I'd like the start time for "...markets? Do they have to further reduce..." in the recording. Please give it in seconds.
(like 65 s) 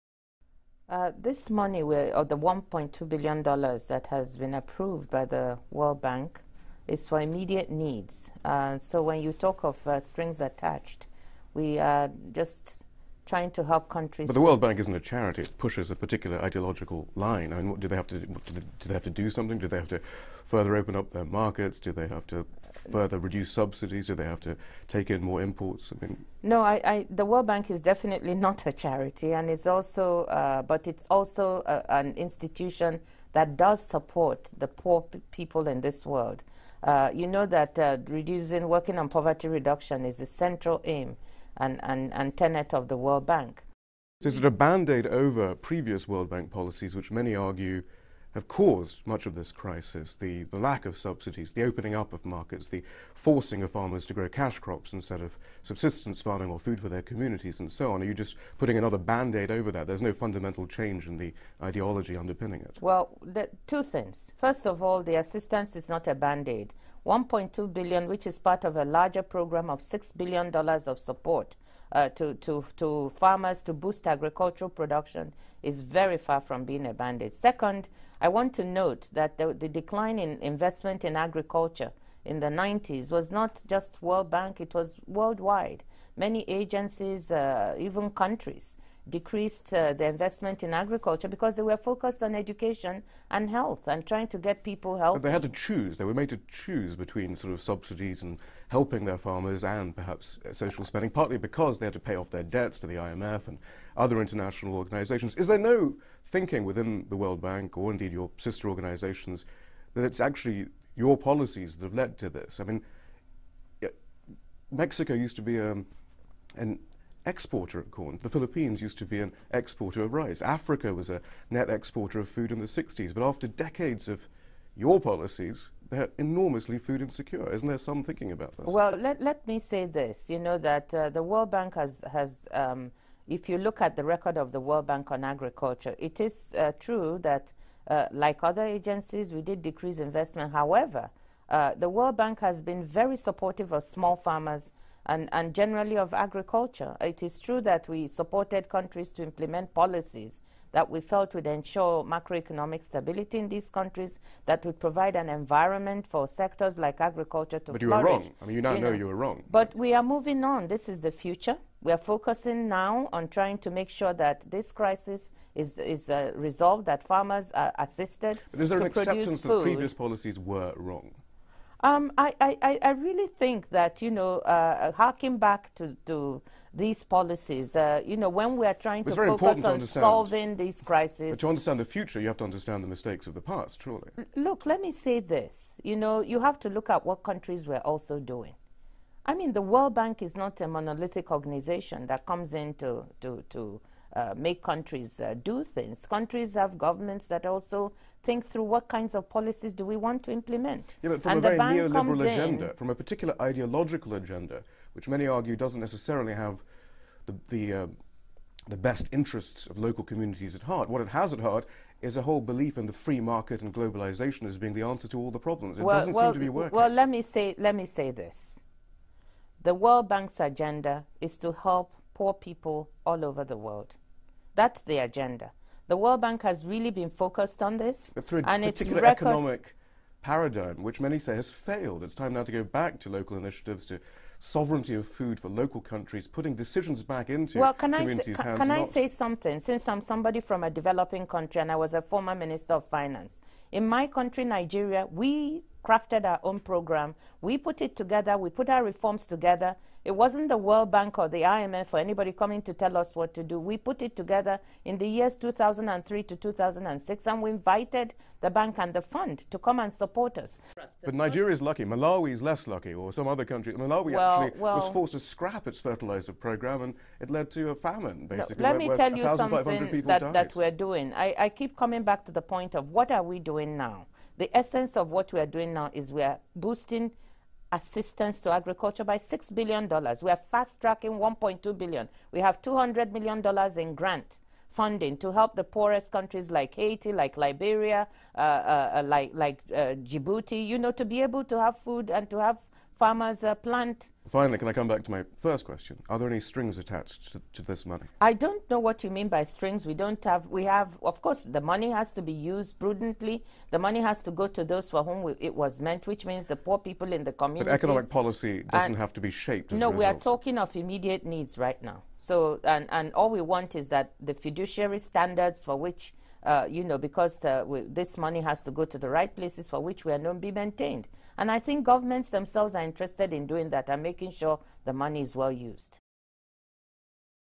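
21 s.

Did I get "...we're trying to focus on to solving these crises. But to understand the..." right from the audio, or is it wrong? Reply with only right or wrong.
right.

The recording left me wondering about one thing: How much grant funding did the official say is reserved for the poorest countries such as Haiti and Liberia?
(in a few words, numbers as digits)
$200 million.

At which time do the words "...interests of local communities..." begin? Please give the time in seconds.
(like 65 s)
209 s.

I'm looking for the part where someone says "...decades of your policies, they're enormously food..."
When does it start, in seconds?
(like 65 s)
123 s.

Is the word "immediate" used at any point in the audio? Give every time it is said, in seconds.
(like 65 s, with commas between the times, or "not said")
7 s, 310 s.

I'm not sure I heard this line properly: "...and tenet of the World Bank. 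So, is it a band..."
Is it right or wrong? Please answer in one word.
right.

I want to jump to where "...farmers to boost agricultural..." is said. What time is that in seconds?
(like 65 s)
73 s.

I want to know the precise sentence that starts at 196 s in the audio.
Countries have governments that also think through what kinds of policies do we want to implement.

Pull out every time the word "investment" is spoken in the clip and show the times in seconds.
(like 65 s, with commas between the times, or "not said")
80 s, 90 s, 139 s.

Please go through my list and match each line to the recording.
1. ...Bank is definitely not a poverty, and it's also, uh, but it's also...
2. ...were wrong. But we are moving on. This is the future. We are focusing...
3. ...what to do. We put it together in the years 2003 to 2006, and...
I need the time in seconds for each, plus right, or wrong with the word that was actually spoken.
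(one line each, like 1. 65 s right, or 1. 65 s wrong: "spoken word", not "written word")
1. 27 s wrong: "charity", not "poverty"
2. 159 s right
3. 253 s right.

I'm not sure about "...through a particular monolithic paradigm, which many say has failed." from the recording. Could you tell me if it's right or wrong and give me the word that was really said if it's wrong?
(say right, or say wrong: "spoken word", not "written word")
wrong: "economic", not "monolithic".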